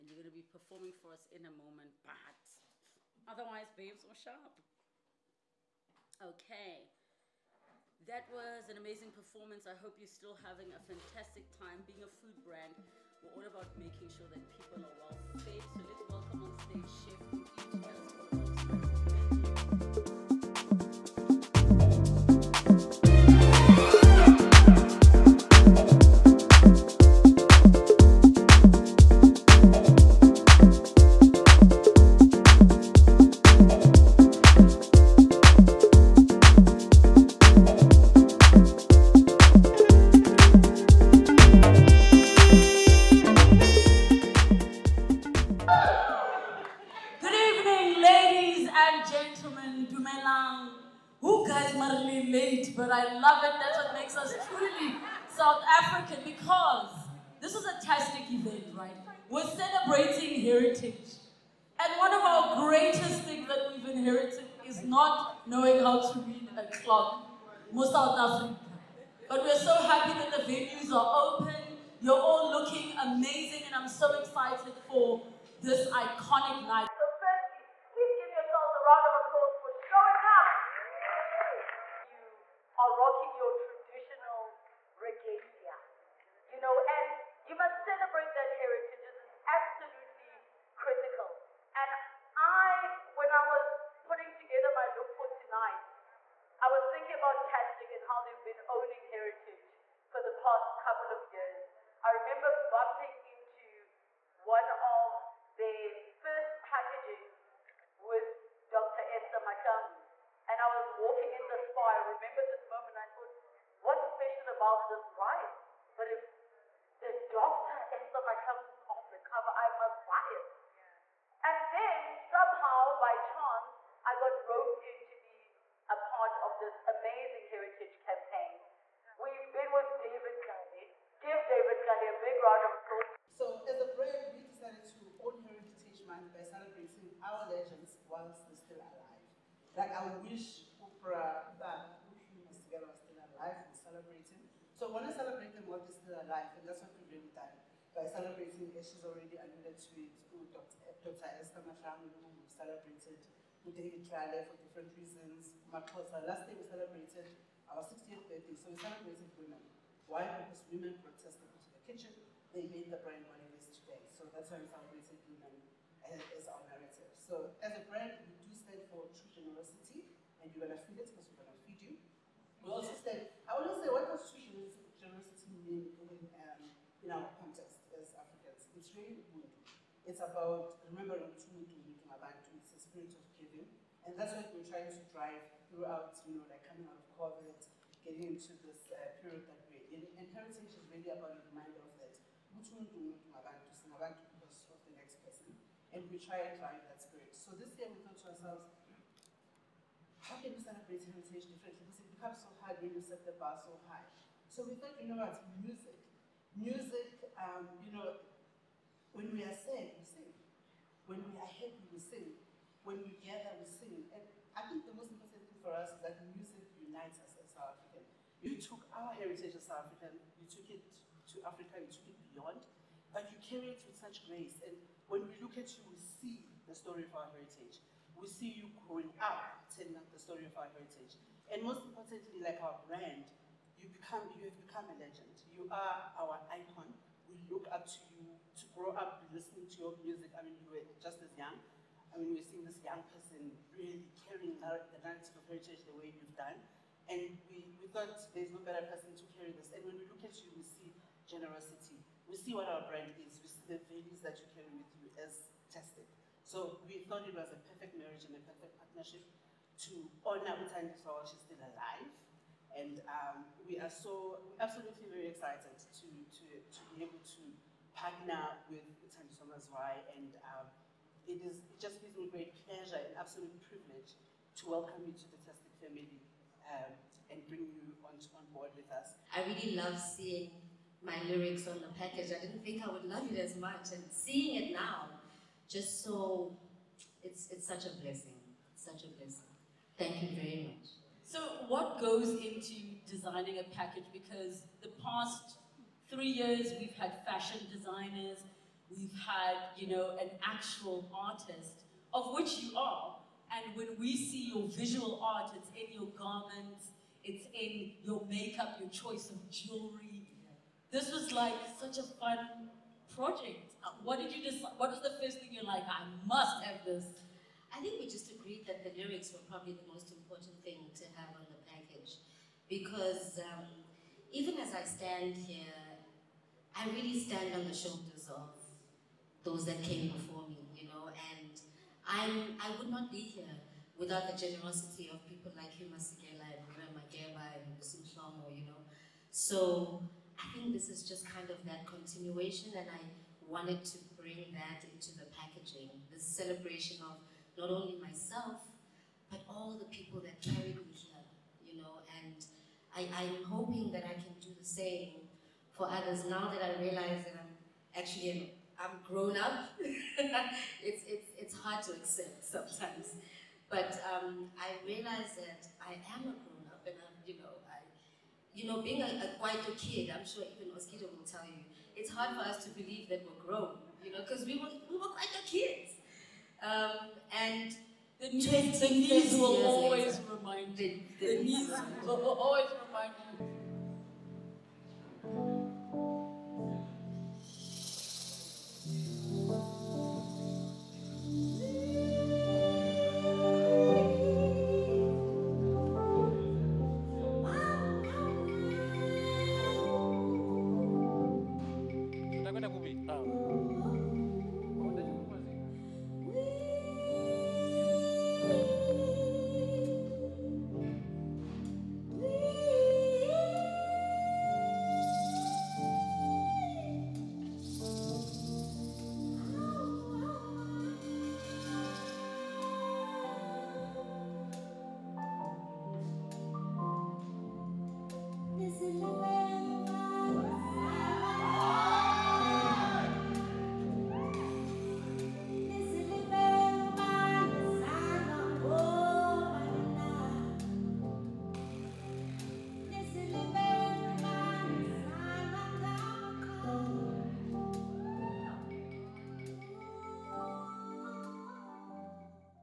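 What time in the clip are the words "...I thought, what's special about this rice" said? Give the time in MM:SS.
01:52.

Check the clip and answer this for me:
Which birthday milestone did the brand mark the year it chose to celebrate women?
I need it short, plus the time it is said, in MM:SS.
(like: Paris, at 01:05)
60th, at 02:37.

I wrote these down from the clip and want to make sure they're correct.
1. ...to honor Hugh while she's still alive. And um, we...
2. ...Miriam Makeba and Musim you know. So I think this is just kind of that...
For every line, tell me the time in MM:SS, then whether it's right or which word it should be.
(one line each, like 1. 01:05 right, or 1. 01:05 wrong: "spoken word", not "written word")
1. 04:19 wrong: "Utandi", not "Hugh"
2. 05:36 right.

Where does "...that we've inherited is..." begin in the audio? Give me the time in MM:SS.
01:03.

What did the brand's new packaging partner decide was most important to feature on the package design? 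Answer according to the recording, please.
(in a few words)
The lyrics.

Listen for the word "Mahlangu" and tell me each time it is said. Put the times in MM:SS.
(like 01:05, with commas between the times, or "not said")
01:49, 01:58, 02:31.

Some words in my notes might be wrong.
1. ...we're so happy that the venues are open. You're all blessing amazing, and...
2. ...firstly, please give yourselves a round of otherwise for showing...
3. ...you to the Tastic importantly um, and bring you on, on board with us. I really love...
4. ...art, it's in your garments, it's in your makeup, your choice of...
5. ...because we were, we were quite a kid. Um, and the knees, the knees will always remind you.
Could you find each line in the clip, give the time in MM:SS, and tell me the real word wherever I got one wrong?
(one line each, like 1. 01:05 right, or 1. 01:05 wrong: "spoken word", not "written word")
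1. 01:09 wrong: "looking", not "blessing"
2. 01:17 wrong: "applause", not "otherwise"
3. 04:35 wrong: "family", not "importantly"
4. 05:05 right
5. 06:14 right.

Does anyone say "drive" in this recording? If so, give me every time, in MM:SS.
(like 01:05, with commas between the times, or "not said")
03:05, 03:16.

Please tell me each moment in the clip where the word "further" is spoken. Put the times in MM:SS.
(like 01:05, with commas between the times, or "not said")
not said.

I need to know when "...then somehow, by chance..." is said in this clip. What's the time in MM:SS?
02:01.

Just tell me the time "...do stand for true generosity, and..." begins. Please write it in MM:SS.
02:48.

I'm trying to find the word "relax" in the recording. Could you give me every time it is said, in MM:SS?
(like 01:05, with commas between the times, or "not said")
not said.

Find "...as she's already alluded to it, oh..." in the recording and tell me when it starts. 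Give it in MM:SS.
02:28.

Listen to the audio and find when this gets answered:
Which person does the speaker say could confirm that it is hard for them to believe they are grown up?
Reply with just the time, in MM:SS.
06:10.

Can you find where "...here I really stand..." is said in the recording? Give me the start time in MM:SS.
05:25.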